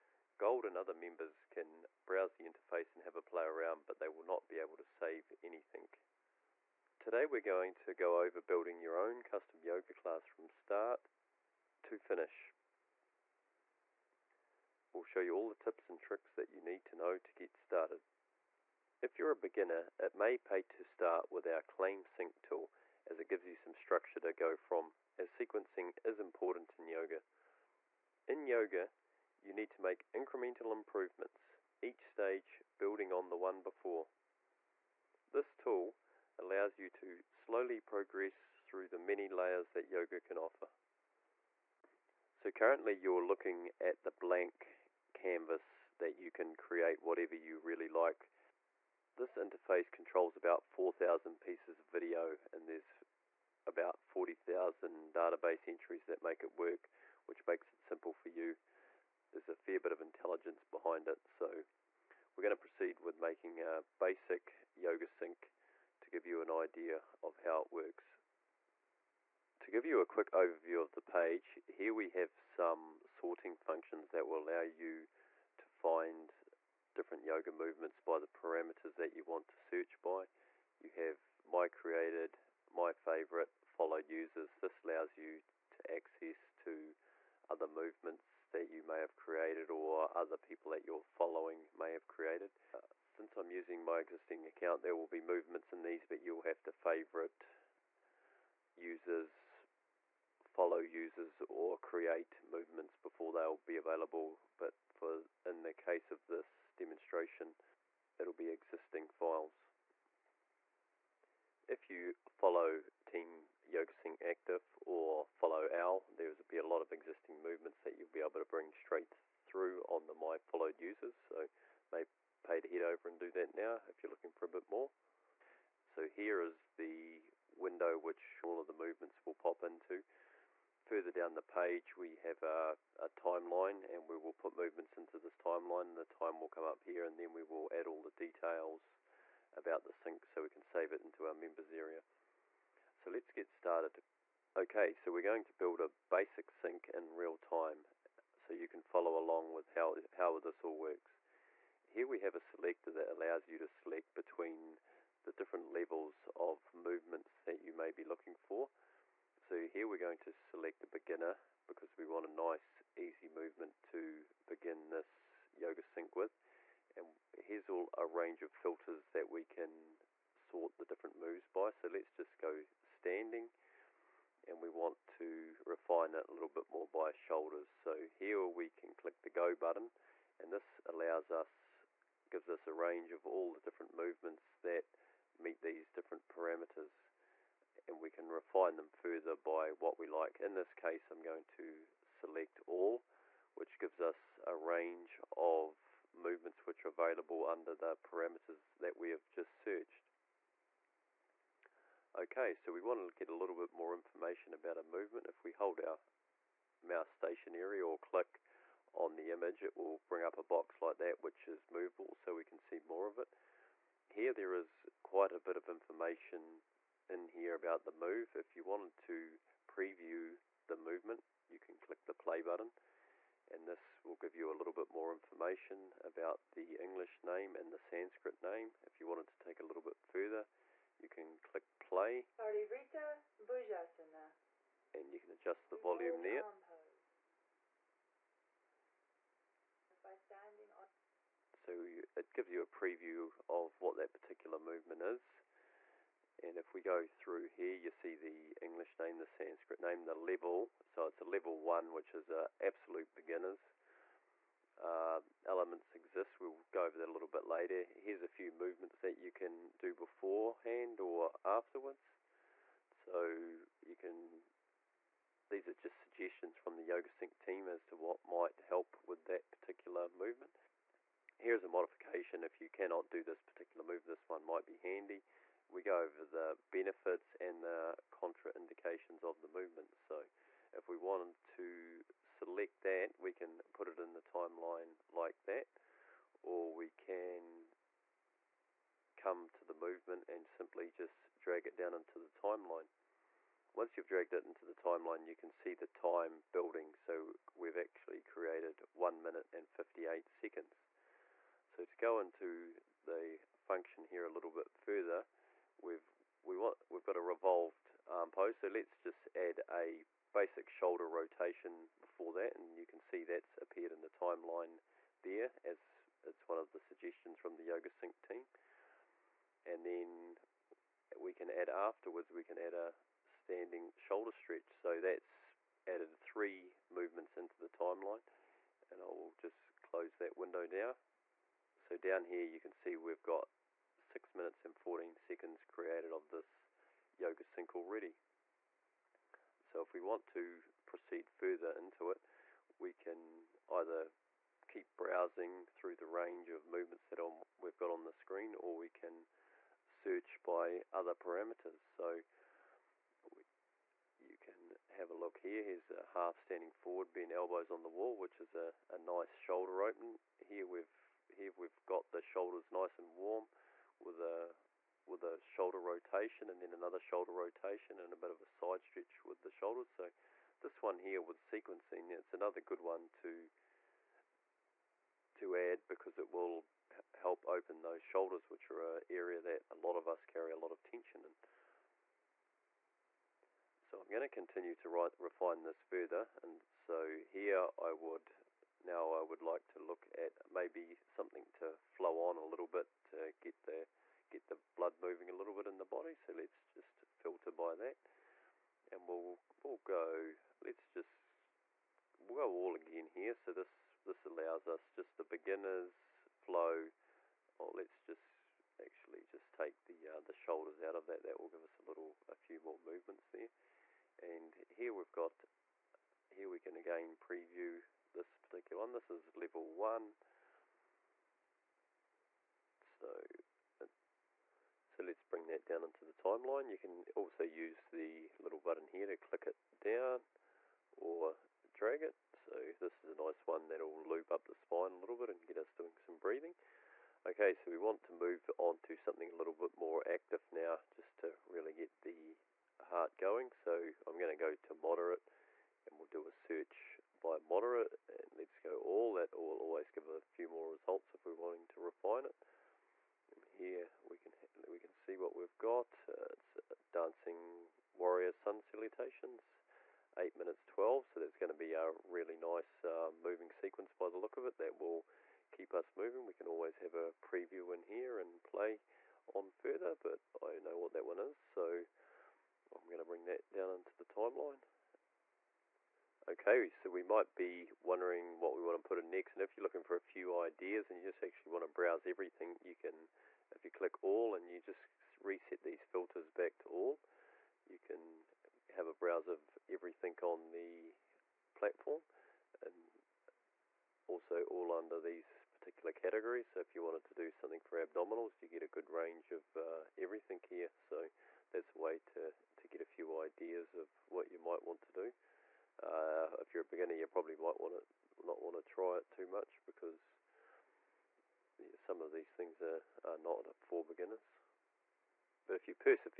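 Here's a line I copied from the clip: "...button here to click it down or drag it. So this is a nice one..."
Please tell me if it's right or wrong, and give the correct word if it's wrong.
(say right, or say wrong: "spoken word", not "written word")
right.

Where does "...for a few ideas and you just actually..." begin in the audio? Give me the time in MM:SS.
07:59.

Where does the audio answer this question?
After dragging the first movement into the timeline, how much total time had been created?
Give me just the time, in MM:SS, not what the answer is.
04:58.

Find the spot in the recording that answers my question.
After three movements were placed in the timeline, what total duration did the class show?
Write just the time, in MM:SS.
05:33.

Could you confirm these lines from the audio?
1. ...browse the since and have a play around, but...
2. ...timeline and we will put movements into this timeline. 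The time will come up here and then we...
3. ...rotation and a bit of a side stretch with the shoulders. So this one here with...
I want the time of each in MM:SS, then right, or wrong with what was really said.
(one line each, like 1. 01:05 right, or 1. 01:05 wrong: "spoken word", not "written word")
1. 00:02 wrong: "interface", not "since"
2. 02:13 right
3. 06:07 right.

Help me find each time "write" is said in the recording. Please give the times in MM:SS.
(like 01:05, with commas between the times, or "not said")
06:24.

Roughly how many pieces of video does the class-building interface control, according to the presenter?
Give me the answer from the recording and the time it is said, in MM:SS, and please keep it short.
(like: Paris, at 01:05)
4,000, at 00:50.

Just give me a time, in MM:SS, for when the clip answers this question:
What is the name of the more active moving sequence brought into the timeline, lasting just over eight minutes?
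07:36.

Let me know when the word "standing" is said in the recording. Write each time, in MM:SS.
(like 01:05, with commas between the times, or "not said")
02:52, 05:23, 05:56.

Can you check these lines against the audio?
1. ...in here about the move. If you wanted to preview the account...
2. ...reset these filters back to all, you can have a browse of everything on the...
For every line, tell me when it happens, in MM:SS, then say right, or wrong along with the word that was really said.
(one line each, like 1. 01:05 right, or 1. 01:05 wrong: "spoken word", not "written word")
1. 03:37 wrong: "movement", not "account"
2. 08:05 right.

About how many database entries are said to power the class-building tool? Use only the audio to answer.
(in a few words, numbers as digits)
40,000.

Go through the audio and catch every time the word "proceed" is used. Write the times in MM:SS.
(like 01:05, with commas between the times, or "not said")
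01:02, 05:40.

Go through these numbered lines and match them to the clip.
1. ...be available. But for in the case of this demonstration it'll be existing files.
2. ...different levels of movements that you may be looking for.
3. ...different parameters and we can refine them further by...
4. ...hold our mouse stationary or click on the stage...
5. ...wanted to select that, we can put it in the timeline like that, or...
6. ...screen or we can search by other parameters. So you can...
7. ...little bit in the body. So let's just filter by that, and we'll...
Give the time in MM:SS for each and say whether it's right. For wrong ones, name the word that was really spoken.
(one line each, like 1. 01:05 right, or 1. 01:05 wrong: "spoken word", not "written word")
1. 01:43 right
2. 02:35 right
3. 03:05 right
4. 03:25 wrong: "image", not "stage"
5. 04:40 right
6. 05:48 right
7. 06:35 right.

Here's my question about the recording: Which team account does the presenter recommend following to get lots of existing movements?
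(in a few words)
Team YogaSync Active.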